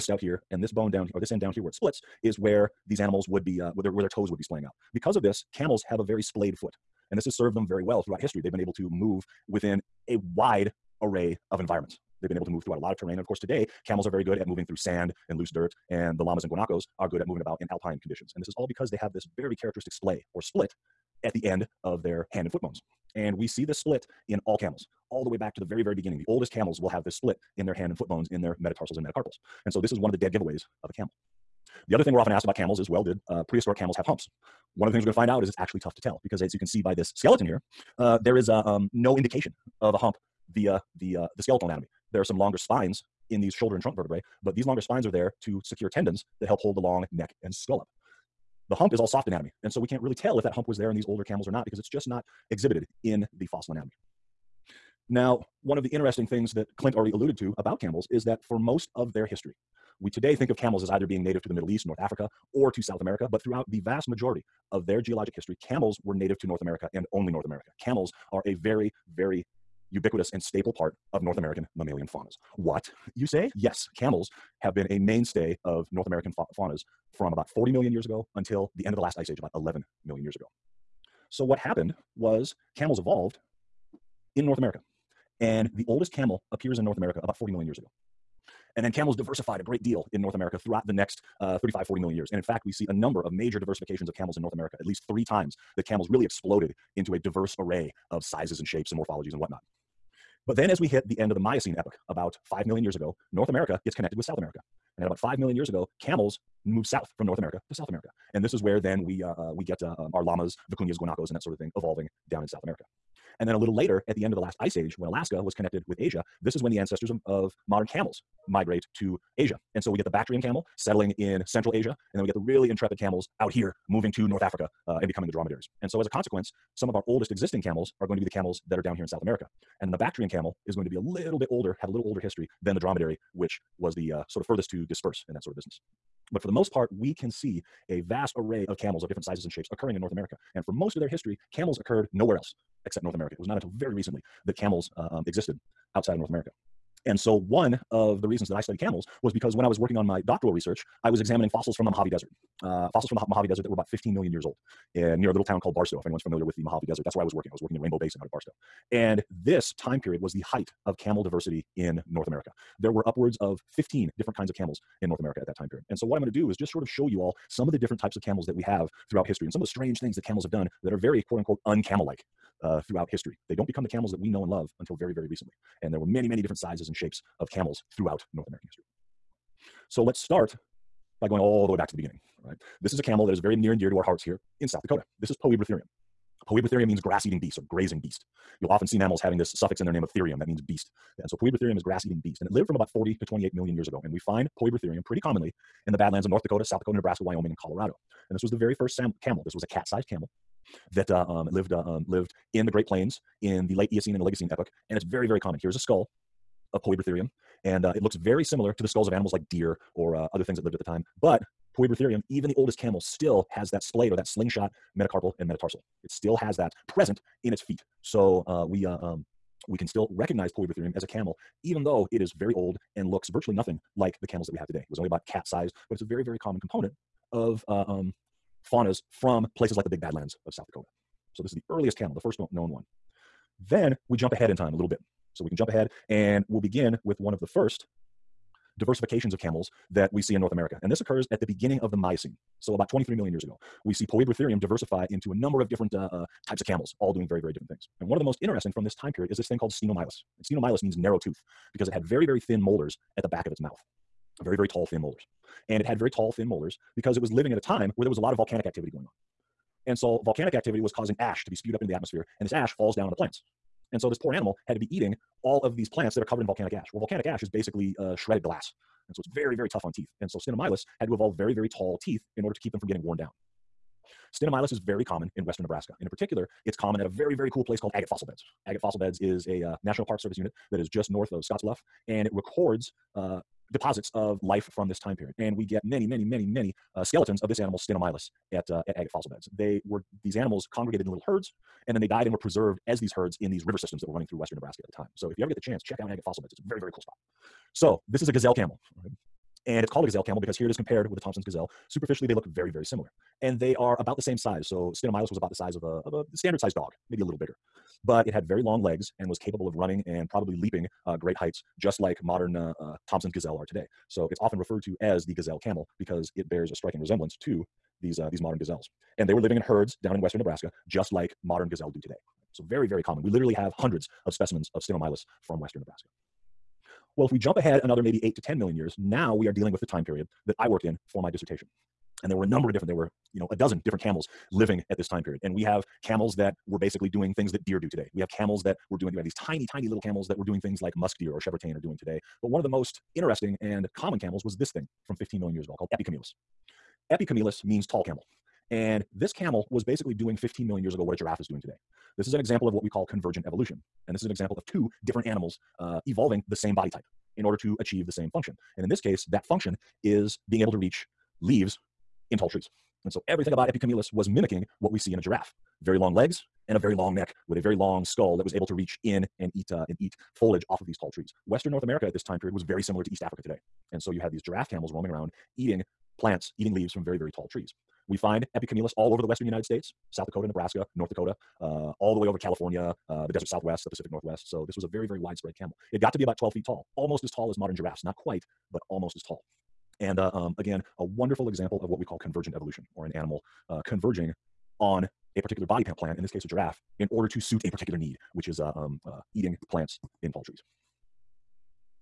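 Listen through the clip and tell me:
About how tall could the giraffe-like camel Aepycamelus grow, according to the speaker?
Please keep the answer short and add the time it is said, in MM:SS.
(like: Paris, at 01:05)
12 feet, at 06:26.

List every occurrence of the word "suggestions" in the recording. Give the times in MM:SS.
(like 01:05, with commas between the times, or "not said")
not said.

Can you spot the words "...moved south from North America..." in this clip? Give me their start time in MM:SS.
01:46.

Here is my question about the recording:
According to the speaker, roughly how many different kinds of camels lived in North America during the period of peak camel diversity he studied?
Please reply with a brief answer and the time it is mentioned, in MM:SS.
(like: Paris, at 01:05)
15, at 02:43.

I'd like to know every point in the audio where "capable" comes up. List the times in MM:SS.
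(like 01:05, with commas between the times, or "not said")
05:09.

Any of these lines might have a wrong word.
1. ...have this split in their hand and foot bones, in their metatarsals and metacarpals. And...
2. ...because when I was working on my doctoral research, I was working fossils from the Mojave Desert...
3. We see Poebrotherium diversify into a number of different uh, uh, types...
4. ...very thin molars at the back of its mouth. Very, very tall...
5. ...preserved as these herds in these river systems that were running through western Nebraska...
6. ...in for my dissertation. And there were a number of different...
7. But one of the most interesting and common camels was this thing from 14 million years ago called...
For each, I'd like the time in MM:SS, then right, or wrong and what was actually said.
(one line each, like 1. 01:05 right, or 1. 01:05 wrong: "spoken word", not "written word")
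1. 00:26 right
2. 02:29 wrong: "examining", not "working"
3. 04:03 right
4. 04:12 right
5. 04:52 right
6. 05:30 right
7. 05:42 wrong: "15", not "14".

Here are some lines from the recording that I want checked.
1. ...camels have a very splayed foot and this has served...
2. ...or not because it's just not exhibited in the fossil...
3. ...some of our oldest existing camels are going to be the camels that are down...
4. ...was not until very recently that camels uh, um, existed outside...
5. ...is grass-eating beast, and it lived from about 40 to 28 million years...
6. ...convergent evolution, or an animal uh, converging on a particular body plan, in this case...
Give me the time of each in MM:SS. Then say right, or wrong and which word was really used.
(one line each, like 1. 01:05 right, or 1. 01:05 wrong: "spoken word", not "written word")
1. 00:05 right
2. 00:51 right
3. 02:06 right
4. 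02:23 right
5. 03:11 right
6. 06:32 right.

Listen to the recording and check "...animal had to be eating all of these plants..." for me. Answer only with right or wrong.
right.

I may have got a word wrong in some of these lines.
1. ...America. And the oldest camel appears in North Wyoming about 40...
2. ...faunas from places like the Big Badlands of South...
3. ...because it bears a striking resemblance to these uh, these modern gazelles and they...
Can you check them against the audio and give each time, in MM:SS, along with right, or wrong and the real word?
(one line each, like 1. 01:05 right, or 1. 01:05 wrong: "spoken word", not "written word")
1. 01:24 wrong: "America", not "Wyoming"
2. 03:48 right
3. 05:16 right.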